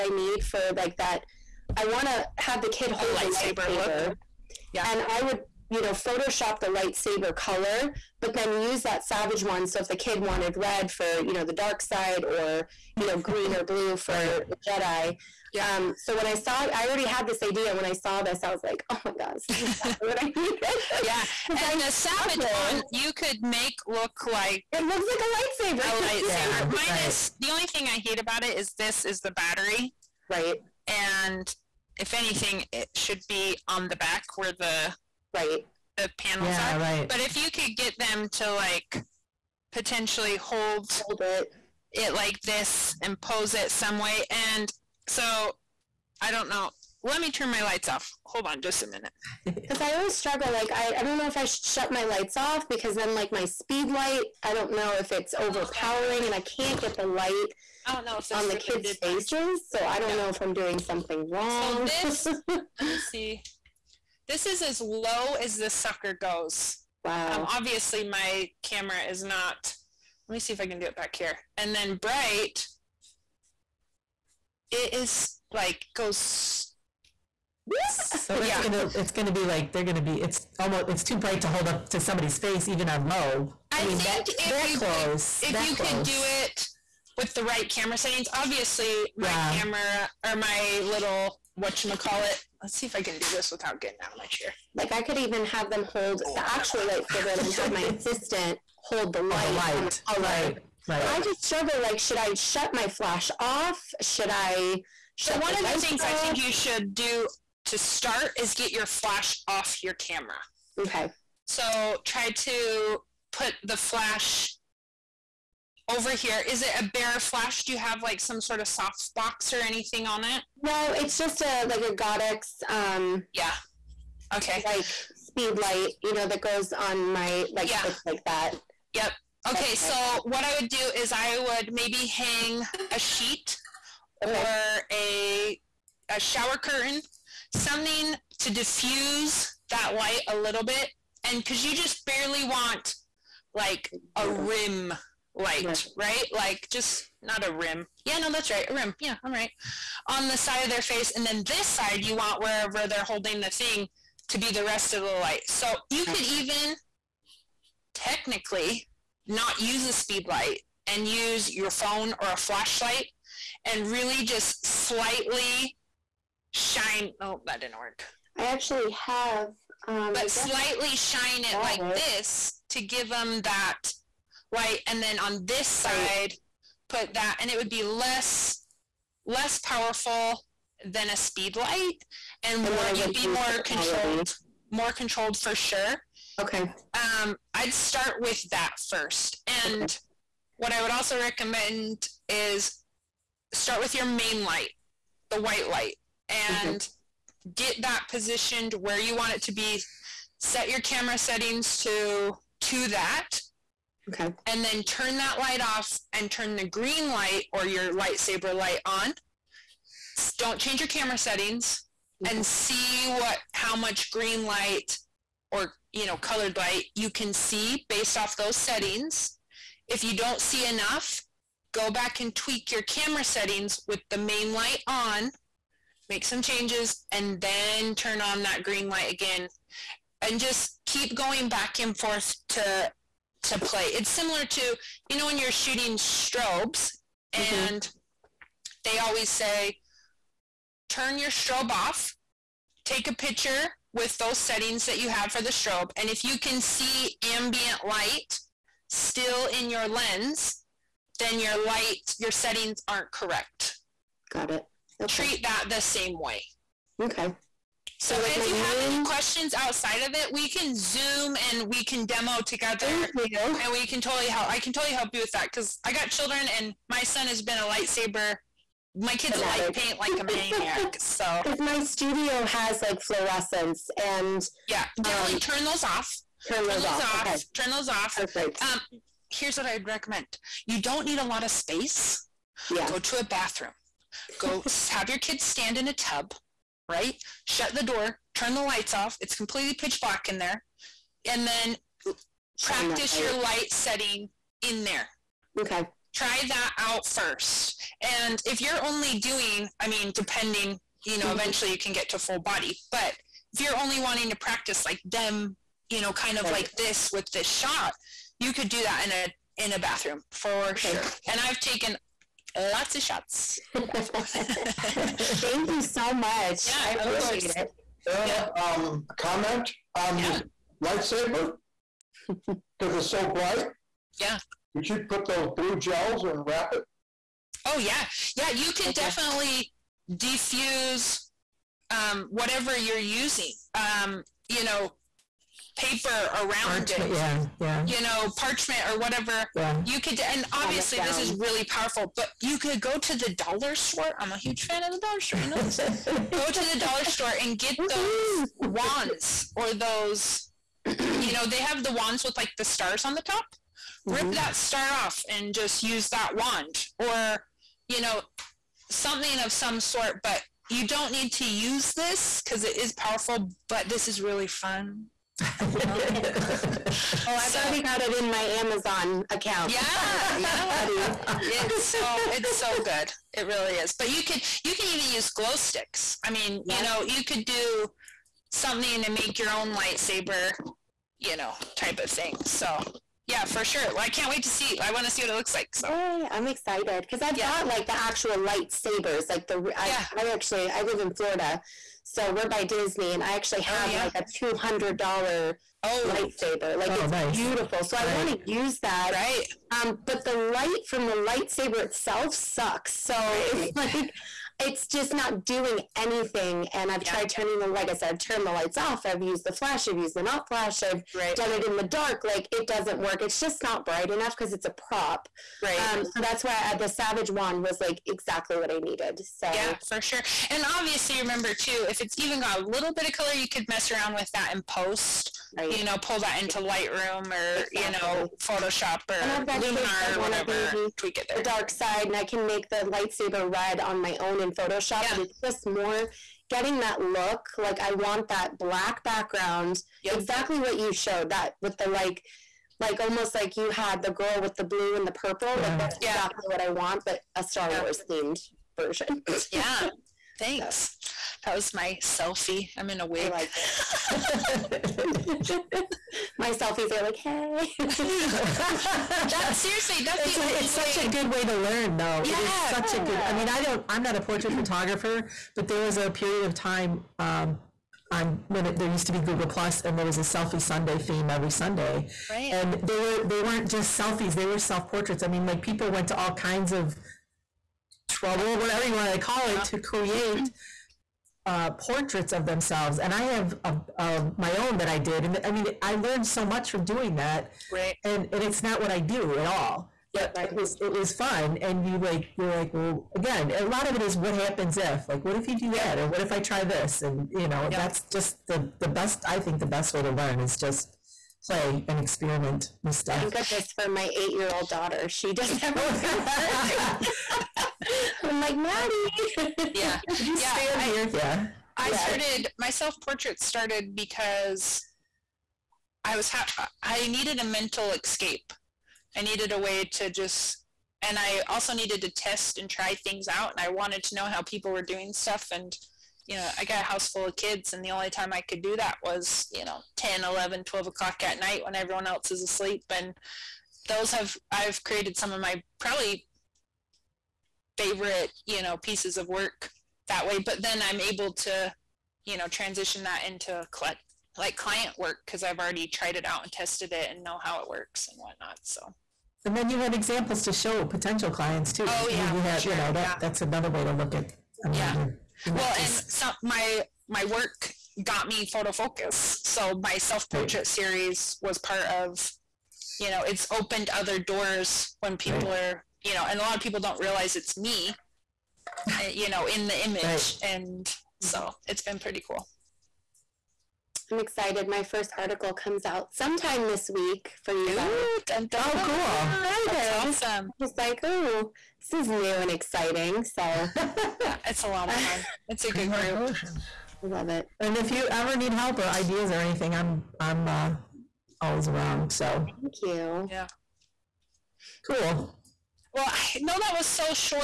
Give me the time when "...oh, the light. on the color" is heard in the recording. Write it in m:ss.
1:39.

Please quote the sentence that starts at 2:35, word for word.
So you could even technically not use a speed light and use your phone or a flashlight and really just slightly shine.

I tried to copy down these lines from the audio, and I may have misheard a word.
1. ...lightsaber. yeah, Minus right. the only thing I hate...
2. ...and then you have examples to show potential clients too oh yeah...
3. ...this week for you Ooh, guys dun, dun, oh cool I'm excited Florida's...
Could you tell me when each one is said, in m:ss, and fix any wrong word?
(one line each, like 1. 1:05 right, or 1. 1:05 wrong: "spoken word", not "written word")
1. 0:26 right
2. 9:09 right
3. 9:36 wrong: "That", not "Florida".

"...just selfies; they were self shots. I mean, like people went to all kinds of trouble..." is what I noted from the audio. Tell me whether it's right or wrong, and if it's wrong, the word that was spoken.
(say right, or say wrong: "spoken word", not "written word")
wrong: "portraits", not "shots".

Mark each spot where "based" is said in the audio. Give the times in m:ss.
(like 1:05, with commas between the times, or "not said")
3:37.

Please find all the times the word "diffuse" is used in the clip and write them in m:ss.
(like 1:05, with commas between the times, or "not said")
2:18, 5:30.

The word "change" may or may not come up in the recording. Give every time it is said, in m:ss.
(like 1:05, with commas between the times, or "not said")
3:30, 3:46.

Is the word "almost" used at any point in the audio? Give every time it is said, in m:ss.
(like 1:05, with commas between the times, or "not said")
1:20, 7:22.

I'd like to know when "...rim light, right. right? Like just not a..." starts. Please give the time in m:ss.
2:24.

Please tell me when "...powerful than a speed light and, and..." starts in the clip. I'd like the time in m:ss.
2:59.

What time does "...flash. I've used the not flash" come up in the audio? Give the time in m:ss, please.
6:49.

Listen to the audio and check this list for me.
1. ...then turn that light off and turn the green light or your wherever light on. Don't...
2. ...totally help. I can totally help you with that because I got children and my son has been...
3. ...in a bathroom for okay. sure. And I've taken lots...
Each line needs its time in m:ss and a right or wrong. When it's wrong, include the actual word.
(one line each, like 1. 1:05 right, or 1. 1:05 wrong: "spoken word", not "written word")
1. 3:24 wrong: "lightsaber", not "wherever"
2. 4:24 right
3. 5:09 right.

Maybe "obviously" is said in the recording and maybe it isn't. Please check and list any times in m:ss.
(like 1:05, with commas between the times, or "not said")
1:07, 1:28, 5:40, 7:00.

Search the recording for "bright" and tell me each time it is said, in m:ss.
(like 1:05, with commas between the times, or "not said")
1:11, 1:21, 5:23, 6:53.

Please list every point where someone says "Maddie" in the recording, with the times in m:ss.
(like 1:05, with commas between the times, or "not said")
8:28.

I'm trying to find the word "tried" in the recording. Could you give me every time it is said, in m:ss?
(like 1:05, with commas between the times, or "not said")
6:47, 9:05.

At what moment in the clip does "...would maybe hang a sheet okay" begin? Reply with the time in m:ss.
2:11.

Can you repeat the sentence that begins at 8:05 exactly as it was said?
And I mean, I learned so much from doing that.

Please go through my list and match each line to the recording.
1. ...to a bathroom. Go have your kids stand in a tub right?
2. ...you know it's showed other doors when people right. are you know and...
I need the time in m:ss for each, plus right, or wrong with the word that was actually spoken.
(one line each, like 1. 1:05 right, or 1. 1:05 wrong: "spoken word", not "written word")
1. 4:42 right
2. 9:22 wrong: "opened", not "showed".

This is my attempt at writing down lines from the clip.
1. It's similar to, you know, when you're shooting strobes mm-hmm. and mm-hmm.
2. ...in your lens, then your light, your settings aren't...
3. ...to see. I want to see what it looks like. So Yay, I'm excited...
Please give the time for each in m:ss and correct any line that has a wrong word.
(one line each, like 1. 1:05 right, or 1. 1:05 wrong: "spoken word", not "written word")
1. 3:53 right
2. 4:09 right
3. 6:24 right.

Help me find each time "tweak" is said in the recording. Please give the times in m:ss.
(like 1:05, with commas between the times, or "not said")
3:42, 7:10.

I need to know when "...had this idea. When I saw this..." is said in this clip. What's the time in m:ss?
0:17.